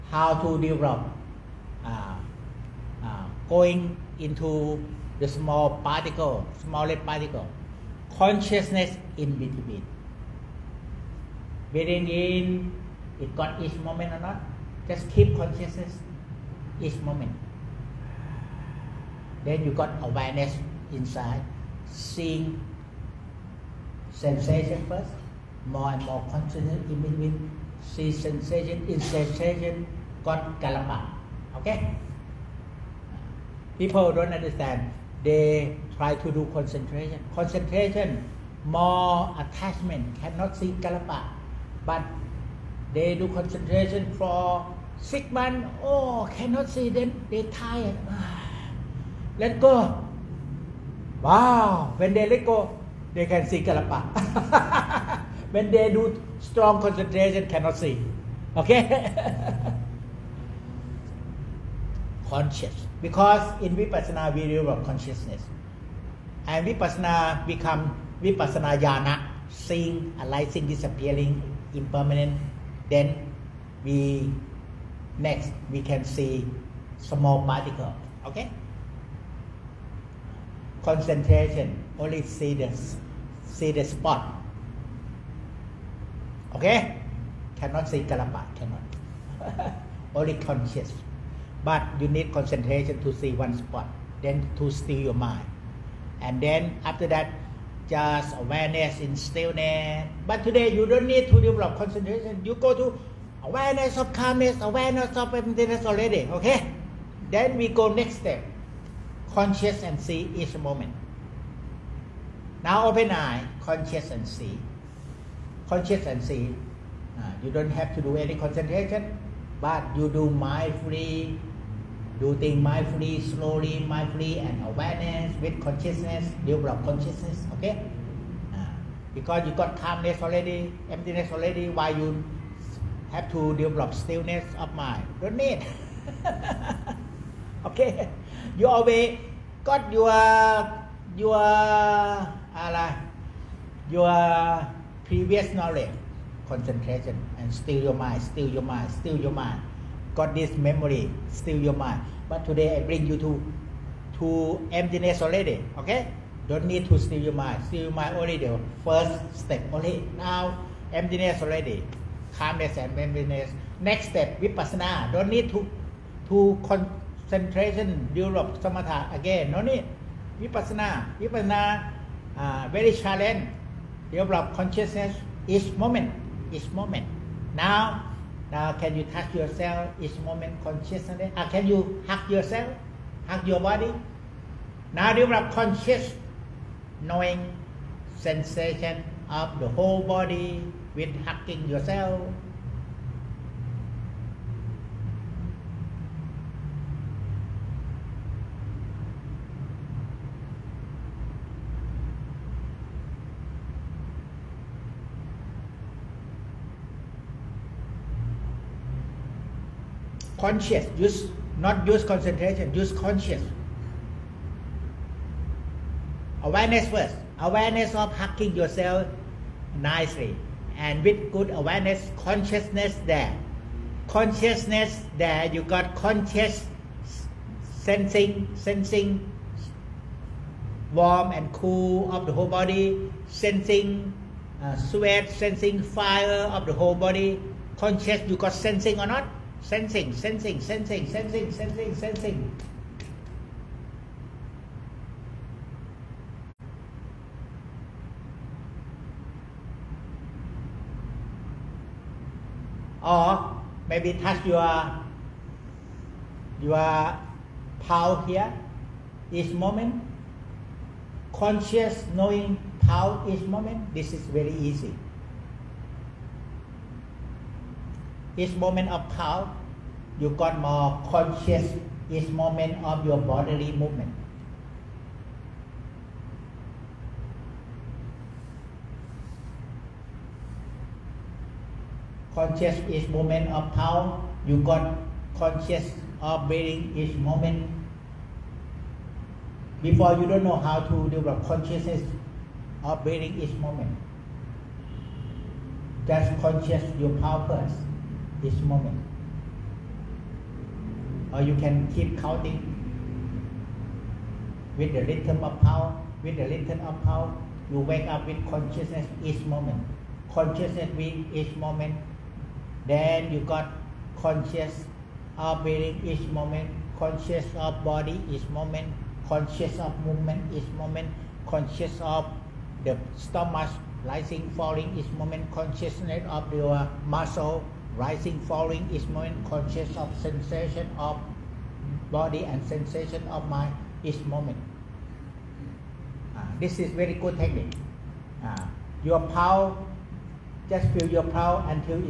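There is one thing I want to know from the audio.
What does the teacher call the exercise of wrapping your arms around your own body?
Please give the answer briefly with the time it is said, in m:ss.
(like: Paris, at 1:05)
Hug yourself, at 3:02.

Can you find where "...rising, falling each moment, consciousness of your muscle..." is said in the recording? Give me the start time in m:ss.
5:24.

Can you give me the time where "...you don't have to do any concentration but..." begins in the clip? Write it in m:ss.
1:57.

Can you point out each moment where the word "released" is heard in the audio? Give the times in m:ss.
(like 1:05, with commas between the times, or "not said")
not said.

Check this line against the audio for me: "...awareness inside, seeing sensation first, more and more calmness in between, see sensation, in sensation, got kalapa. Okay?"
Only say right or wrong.
wrong.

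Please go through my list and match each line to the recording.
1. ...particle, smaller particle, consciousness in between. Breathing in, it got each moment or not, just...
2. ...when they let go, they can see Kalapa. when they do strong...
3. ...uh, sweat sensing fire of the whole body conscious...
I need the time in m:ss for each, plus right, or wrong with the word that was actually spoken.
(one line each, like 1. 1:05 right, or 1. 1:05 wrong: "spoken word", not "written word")
1. 0:05 right
2. 0:51 right
3. 3:54 right.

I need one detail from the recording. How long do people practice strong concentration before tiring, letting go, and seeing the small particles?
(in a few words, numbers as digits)
6 months.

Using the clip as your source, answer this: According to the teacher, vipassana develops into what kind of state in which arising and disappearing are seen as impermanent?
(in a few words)
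Vipassana jhana.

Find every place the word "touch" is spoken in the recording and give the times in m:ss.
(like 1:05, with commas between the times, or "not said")
2:59, 4:14.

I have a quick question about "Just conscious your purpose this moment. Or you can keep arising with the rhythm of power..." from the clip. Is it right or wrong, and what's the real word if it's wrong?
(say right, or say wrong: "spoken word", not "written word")
wrong: "counting", not "arising".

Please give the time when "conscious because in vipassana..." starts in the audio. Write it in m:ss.
1:02.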